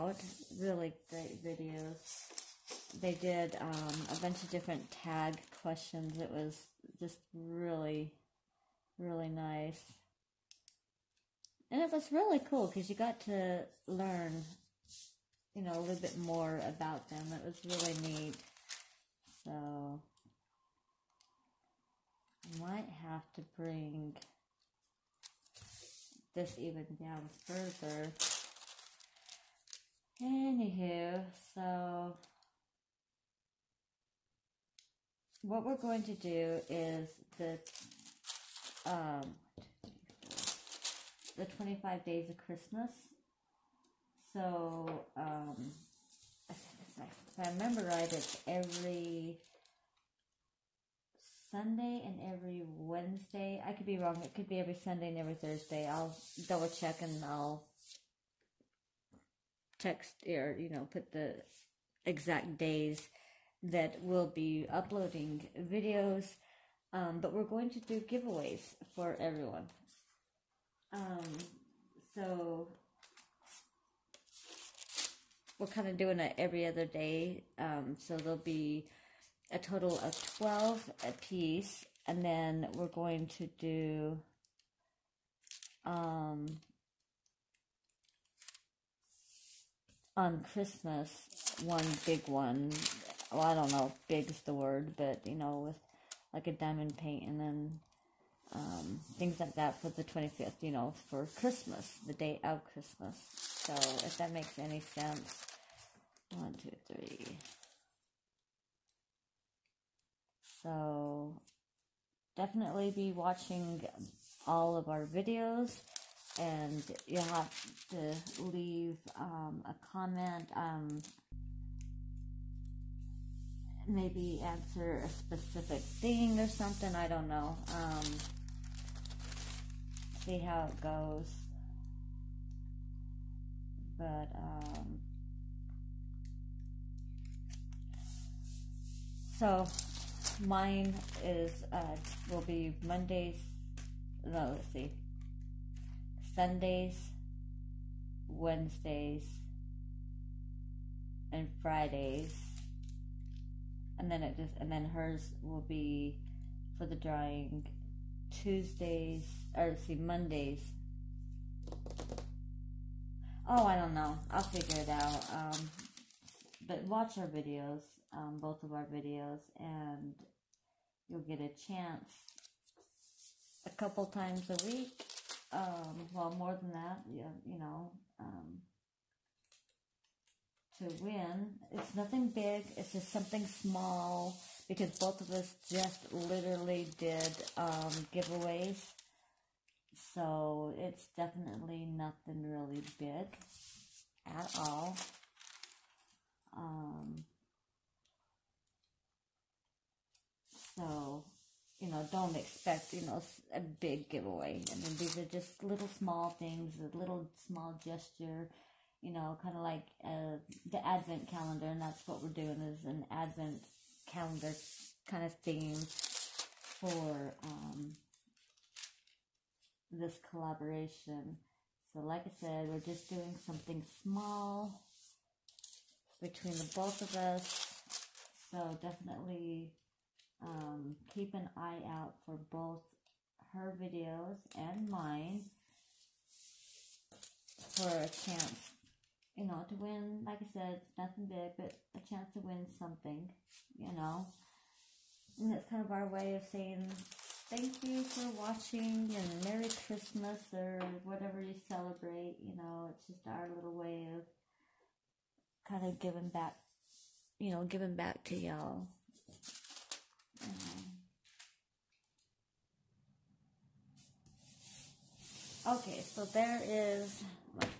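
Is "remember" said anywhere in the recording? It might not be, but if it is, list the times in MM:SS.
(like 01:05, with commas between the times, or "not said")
00:47.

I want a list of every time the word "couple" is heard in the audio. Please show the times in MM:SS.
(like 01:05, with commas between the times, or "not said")
02:53.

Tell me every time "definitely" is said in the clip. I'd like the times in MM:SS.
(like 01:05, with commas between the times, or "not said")
01:52, 03:11, 03:48.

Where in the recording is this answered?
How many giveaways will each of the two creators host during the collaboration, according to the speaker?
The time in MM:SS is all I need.
01:20.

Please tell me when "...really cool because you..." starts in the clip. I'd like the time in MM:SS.
00:12.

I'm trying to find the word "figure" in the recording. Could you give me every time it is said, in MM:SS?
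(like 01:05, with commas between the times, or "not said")
02:44.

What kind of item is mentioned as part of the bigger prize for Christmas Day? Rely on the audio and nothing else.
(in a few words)
diamond paint.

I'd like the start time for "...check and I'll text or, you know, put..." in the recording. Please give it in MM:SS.
00:56.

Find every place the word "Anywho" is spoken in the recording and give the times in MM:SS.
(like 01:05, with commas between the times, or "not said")
00:30.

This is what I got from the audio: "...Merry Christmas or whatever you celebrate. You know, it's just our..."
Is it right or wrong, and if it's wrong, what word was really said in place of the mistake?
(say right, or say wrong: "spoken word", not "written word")
right.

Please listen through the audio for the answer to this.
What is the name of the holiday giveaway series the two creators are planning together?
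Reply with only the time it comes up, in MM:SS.
00:41.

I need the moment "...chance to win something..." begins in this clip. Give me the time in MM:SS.
04:02.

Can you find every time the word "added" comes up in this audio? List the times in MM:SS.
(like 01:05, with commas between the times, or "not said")
not said.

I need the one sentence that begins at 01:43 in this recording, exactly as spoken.
So, if that makes any sense, one, two, three.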